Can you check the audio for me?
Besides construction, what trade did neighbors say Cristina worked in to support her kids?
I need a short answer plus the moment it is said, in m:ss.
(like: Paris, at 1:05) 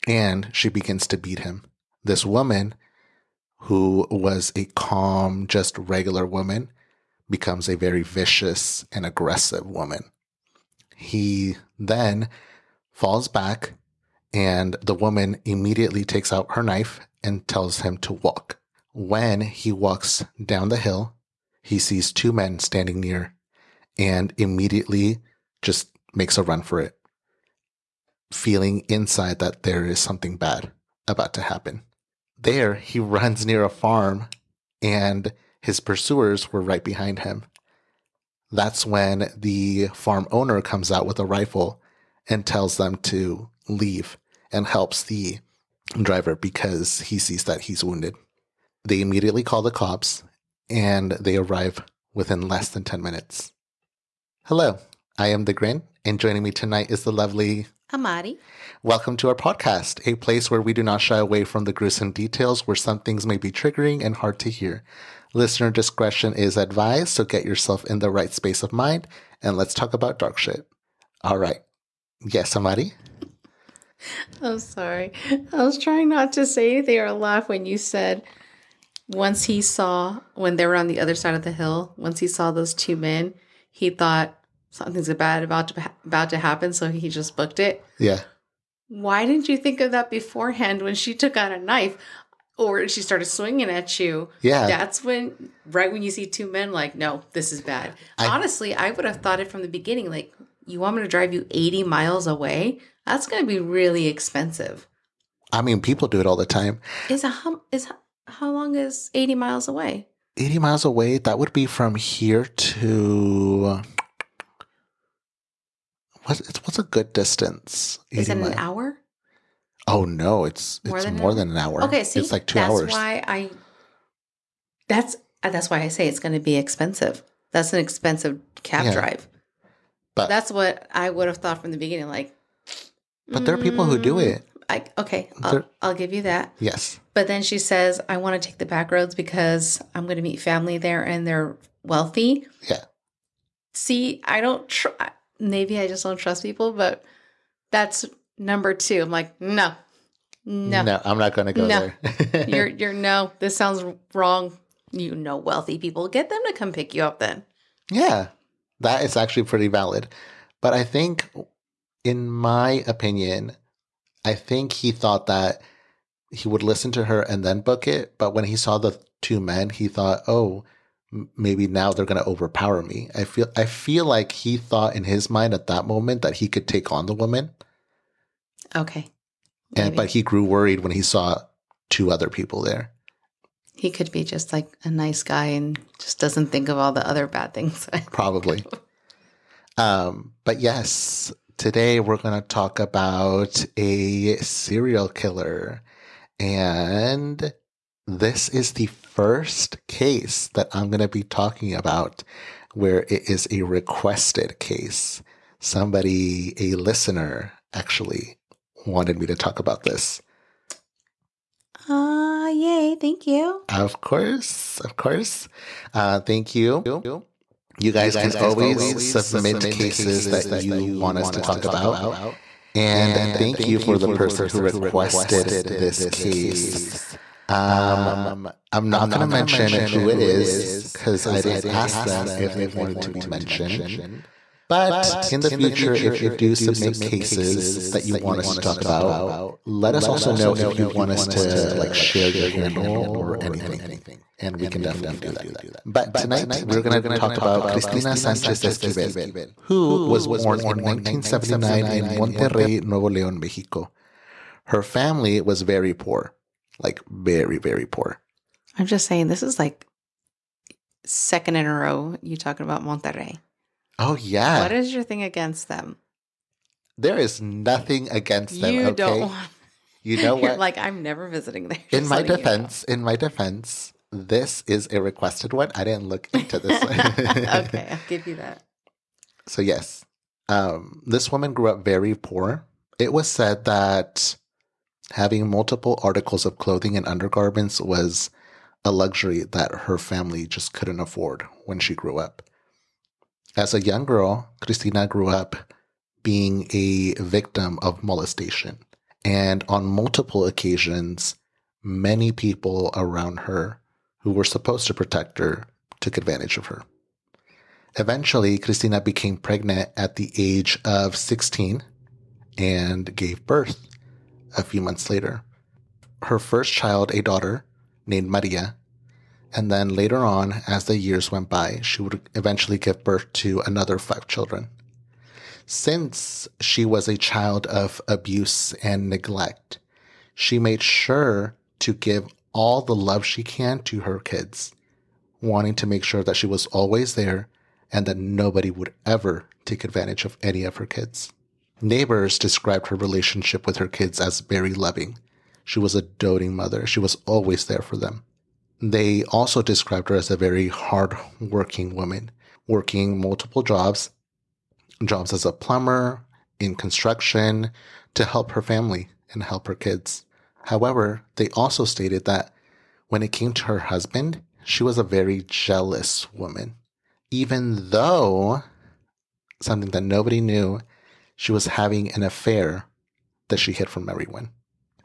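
plumber, at 5:55.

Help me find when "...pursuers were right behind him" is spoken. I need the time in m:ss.
0:35.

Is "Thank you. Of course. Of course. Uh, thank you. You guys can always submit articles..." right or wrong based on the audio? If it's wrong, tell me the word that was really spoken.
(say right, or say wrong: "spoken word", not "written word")
wrong: "cases", not "articles".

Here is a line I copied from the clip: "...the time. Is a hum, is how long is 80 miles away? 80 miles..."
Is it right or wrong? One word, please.
right.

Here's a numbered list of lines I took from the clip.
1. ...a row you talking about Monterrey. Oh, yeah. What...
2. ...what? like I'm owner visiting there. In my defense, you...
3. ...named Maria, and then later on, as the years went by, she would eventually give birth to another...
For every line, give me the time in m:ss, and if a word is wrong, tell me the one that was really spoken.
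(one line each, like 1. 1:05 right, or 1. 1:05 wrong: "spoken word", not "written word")
1. 4:21 right
2. 4:30 wrong: "never", not "owner"
3. 5:18 right.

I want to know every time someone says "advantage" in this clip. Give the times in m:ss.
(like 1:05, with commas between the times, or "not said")
5:06, 5:39.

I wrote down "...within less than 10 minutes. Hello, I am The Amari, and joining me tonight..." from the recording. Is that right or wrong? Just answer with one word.
wrong.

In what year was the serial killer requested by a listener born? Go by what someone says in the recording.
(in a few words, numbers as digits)
1979.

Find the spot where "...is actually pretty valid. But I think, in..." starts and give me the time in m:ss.
2:39.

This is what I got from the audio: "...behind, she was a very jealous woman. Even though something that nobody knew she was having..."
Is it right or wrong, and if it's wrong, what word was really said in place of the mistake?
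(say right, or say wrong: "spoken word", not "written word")
wrong: "husband", not "behind".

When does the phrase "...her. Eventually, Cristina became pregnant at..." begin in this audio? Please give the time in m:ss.
5:06.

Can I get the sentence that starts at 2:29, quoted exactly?
I'm like, no, no, no I'm not going to go no.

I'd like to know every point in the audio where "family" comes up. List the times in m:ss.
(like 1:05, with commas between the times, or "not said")
2:20, 4:14, 4:49, 5:58.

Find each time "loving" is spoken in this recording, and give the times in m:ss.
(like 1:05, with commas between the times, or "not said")
5:44.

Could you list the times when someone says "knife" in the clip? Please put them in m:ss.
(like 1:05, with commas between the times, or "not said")
0:16, 1:31.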